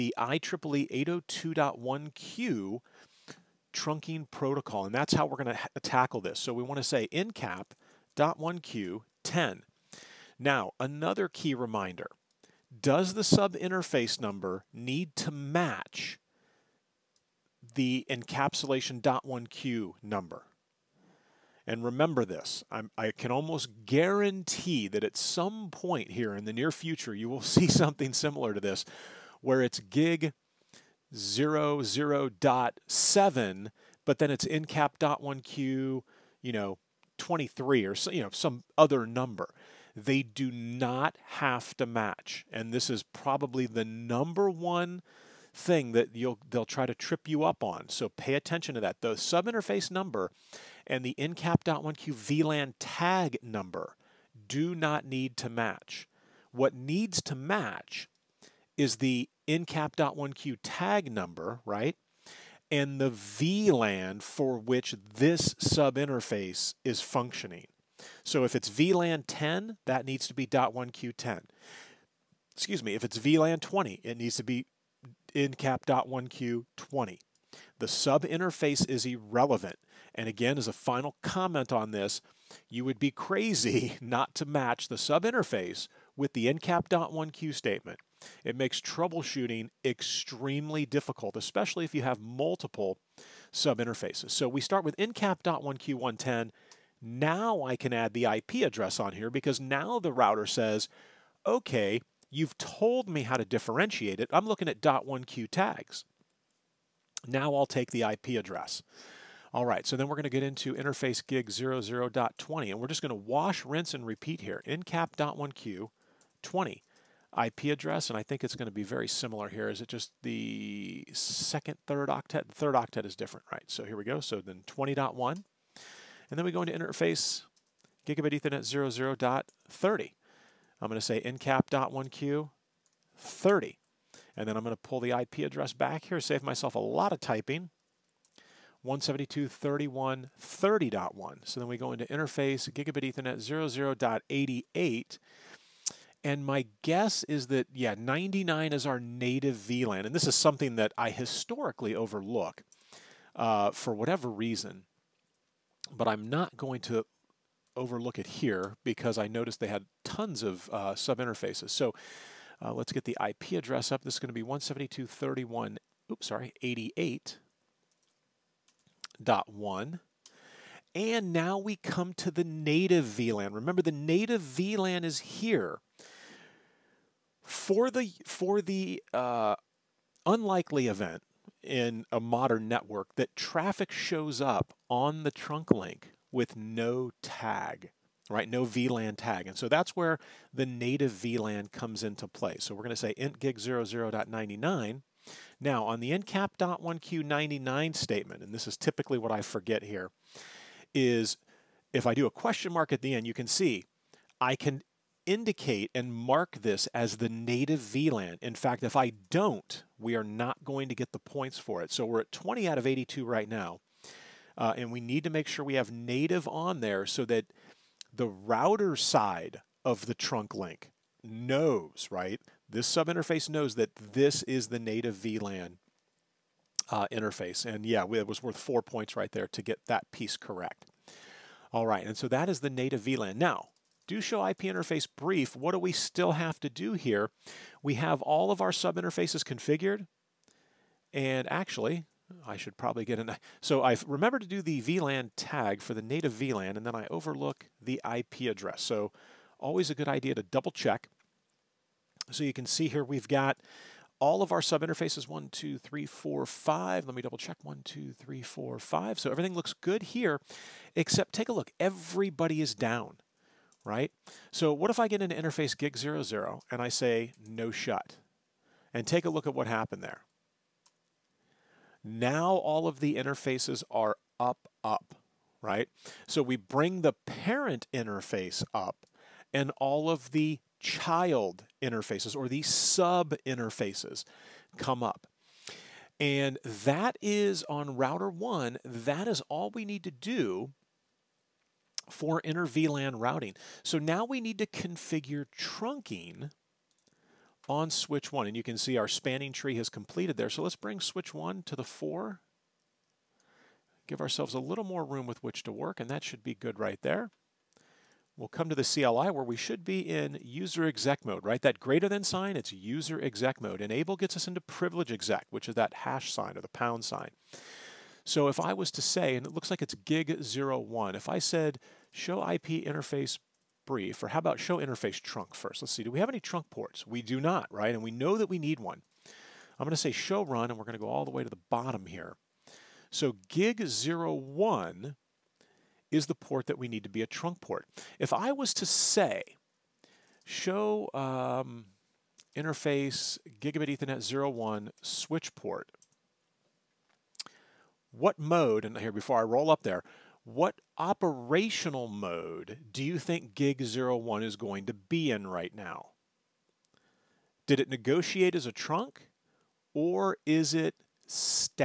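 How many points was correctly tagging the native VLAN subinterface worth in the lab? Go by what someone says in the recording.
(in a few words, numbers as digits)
4.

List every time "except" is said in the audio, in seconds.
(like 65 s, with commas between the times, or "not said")
260 s.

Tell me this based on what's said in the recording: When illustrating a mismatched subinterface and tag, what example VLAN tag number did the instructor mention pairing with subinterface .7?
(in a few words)
23.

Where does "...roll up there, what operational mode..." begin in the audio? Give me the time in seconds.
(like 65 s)
349 s.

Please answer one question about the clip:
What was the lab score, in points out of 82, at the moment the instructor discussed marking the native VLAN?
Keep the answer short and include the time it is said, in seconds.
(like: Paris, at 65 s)
20, at 212 s.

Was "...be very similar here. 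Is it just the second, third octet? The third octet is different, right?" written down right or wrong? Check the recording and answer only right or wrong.
right.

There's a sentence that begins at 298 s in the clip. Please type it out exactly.
And you can see our spanning tree has completed there.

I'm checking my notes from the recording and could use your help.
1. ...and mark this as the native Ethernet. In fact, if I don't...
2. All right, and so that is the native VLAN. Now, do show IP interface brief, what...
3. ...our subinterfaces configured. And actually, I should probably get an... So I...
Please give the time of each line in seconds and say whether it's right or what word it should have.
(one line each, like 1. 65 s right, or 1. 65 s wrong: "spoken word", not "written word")
1. 205 s wrong: "VLAN", not "Ethernet"
2. 231 s right
3. 238 s right.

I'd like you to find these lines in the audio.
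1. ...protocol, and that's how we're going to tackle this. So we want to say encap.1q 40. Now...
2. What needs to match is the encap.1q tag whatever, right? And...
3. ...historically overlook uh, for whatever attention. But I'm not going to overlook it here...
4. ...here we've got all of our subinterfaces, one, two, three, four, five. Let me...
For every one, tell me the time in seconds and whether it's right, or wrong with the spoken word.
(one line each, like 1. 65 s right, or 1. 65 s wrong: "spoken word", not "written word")
1. 4 s wrong: "10", not "40"
2. 56 s wrong: "number", not "whatever"
3. 151 s wrong: "reason", not "attention"
4. 252 s right.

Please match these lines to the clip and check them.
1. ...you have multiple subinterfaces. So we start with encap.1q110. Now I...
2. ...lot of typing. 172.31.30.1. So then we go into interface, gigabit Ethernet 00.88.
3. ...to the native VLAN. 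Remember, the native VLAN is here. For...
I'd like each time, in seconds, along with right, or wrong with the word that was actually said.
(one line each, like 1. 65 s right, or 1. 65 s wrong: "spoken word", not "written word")
1. 91 s right
2. 136 s right
3. 172 s right.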